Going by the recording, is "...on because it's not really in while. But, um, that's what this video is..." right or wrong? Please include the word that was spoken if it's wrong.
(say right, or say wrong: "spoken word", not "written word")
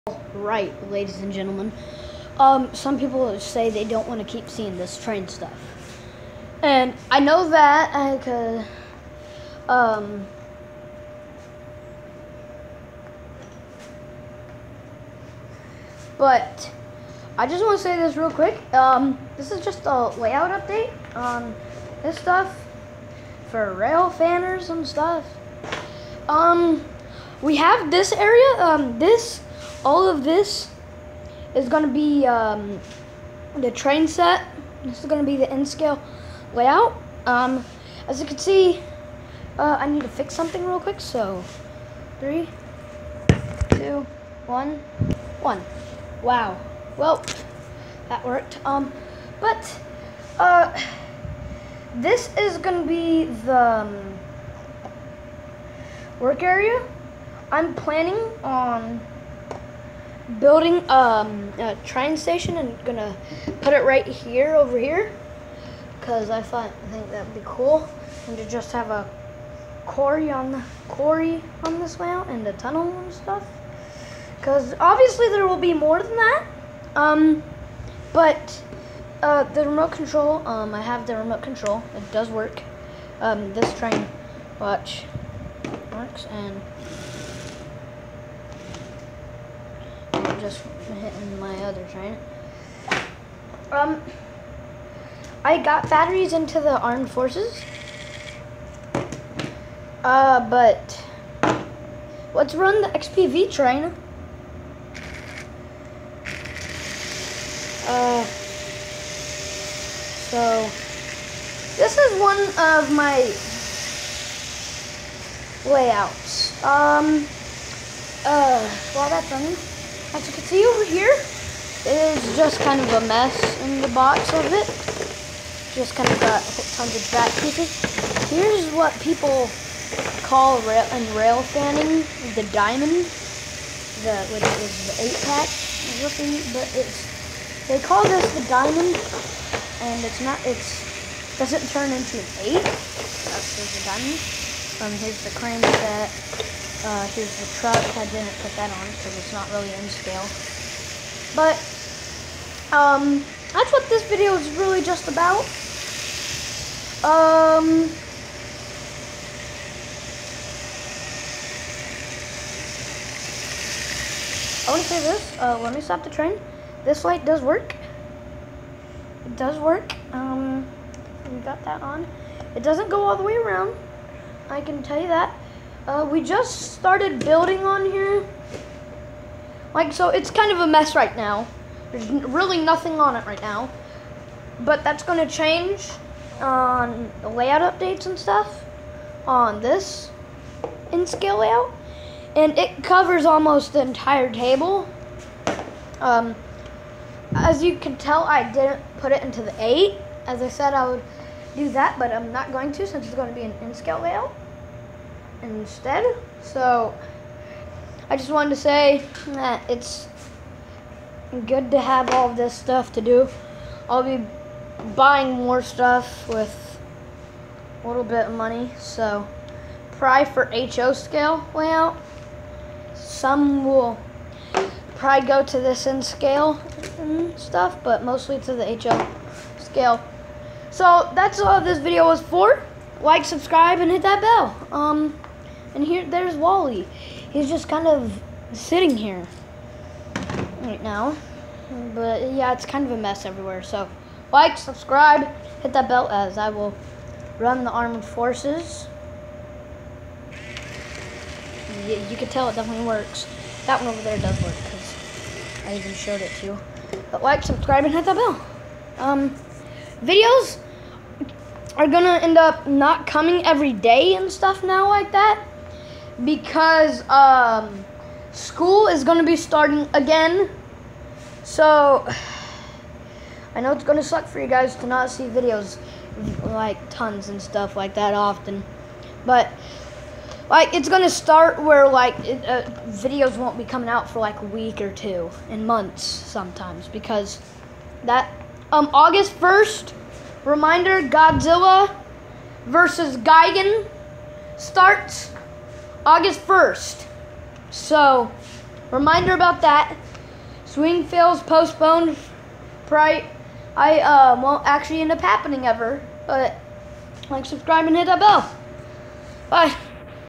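wrong: "scale", not "while".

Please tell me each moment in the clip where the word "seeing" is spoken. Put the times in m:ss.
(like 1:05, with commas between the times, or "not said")
0:04.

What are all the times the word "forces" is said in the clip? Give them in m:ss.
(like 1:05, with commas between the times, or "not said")
1:37, 4:08.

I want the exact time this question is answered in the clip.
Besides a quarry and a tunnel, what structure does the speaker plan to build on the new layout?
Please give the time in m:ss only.
1:01.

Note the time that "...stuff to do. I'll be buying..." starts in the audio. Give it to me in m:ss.
3:32.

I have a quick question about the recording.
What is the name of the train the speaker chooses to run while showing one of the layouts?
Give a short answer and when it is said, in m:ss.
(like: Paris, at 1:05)
XPV, at 1:42.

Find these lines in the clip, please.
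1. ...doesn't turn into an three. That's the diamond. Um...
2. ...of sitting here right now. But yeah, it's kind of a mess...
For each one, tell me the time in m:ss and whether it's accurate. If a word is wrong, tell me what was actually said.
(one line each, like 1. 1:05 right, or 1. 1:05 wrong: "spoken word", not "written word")
1. 2:21 wrong: "eight", not "three"
2. 3:57 right.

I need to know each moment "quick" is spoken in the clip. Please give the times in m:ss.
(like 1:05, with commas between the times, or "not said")
0:18, 0:40.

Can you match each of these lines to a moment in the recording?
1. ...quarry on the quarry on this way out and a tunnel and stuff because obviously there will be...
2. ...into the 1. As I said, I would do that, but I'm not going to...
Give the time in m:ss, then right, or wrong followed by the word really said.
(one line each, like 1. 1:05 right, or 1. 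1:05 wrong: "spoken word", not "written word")
1. 1:09 right
2. 3:19 wrong: "8", not "1".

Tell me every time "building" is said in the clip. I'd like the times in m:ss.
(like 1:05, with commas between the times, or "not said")
1:00, 2:57.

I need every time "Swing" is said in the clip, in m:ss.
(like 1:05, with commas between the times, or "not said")
5:00.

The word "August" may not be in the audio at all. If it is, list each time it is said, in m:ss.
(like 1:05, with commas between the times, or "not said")
4:48, 4:56.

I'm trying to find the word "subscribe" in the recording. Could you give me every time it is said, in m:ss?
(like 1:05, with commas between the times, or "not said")
3:53, 4:04, 4:17, 5:07.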